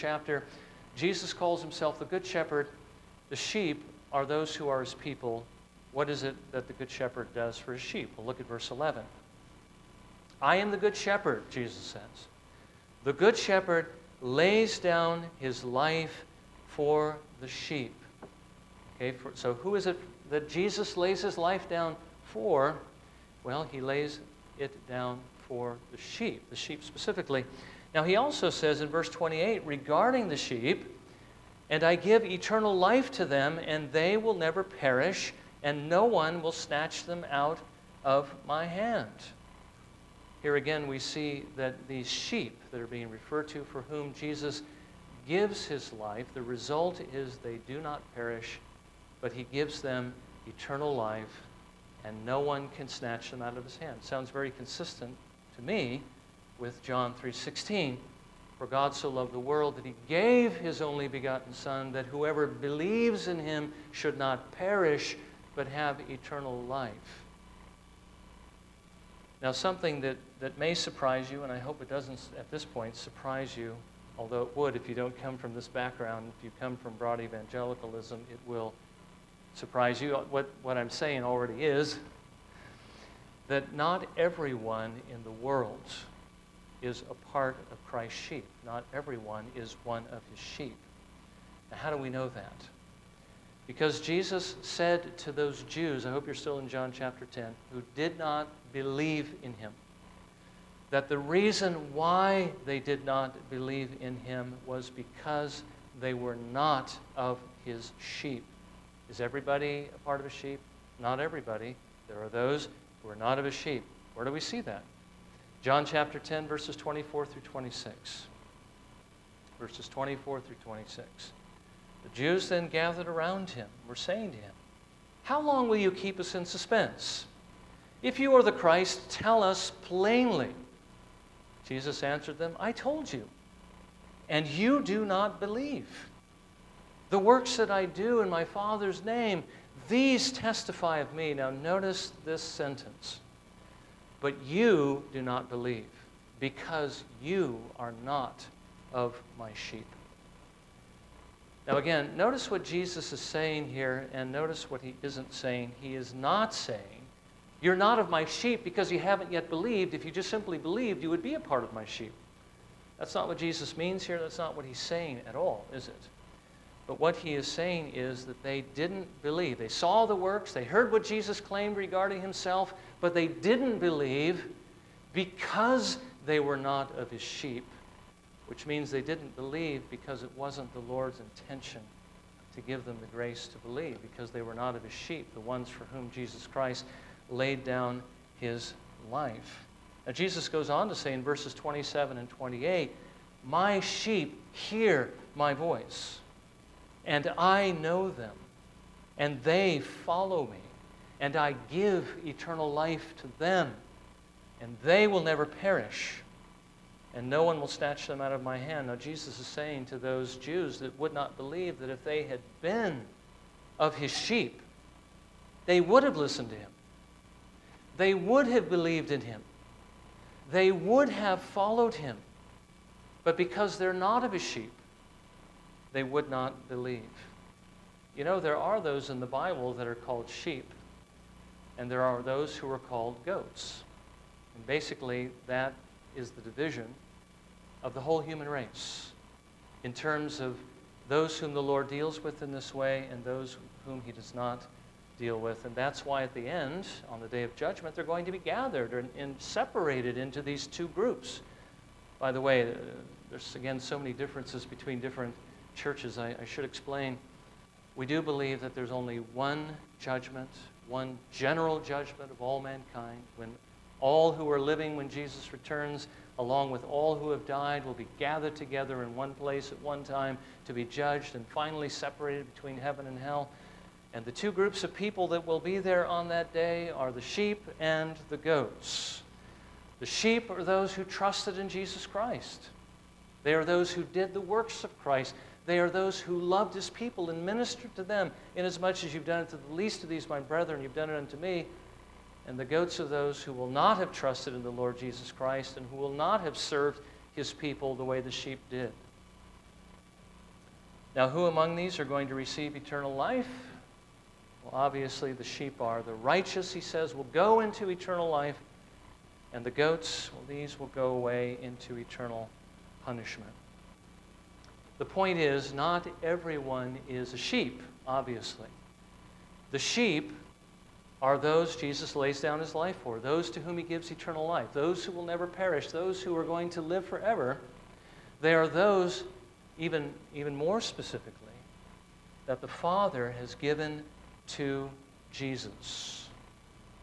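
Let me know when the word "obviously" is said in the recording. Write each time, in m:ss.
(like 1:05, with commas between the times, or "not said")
5:04, 5:18.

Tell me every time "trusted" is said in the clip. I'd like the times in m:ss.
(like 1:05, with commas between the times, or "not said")
4:41, 4:54.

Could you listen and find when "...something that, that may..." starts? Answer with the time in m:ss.
1:09.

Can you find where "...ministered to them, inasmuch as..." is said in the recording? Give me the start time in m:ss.
4:47.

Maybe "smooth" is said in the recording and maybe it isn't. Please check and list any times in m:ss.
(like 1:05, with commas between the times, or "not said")
not said.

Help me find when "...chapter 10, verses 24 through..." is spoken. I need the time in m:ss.
1:55.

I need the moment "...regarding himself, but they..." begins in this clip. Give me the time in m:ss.
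2:51.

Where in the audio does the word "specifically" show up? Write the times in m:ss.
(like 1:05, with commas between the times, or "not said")
0:26, 5:30.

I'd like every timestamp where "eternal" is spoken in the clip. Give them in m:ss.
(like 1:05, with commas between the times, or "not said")
0:32, 0:50, 1:06, 3:22, 5:02, 5:07, 5:11, 5:24.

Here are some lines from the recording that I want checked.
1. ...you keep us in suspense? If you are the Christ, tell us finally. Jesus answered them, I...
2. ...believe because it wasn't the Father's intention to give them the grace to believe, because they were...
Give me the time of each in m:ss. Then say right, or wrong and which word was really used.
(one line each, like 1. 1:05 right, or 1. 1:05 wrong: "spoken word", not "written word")
1. 2:05 wrong: "plainly", not "finally"
2. 2:59 wrong: "Lord", not "Father".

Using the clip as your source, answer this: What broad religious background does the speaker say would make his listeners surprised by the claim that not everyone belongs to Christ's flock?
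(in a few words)
broad evangelicalism.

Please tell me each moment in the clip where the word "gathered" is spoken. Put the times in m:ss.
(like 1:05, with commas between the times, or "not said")
2:02, 4:08, 4:28.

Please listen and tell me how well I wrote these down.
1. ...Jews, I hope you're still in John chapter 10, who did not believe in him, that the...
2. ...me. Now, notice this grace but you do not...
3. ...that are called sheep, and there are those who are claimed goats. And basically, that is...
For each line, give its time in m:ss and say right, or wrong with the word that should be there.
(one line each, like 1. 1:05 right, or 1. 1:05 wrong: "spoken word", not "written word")
1. 1:35 right
2. 2:21 wrong: "sentence", not "grace"
3. 3:49 wrong: "called", not "claimed".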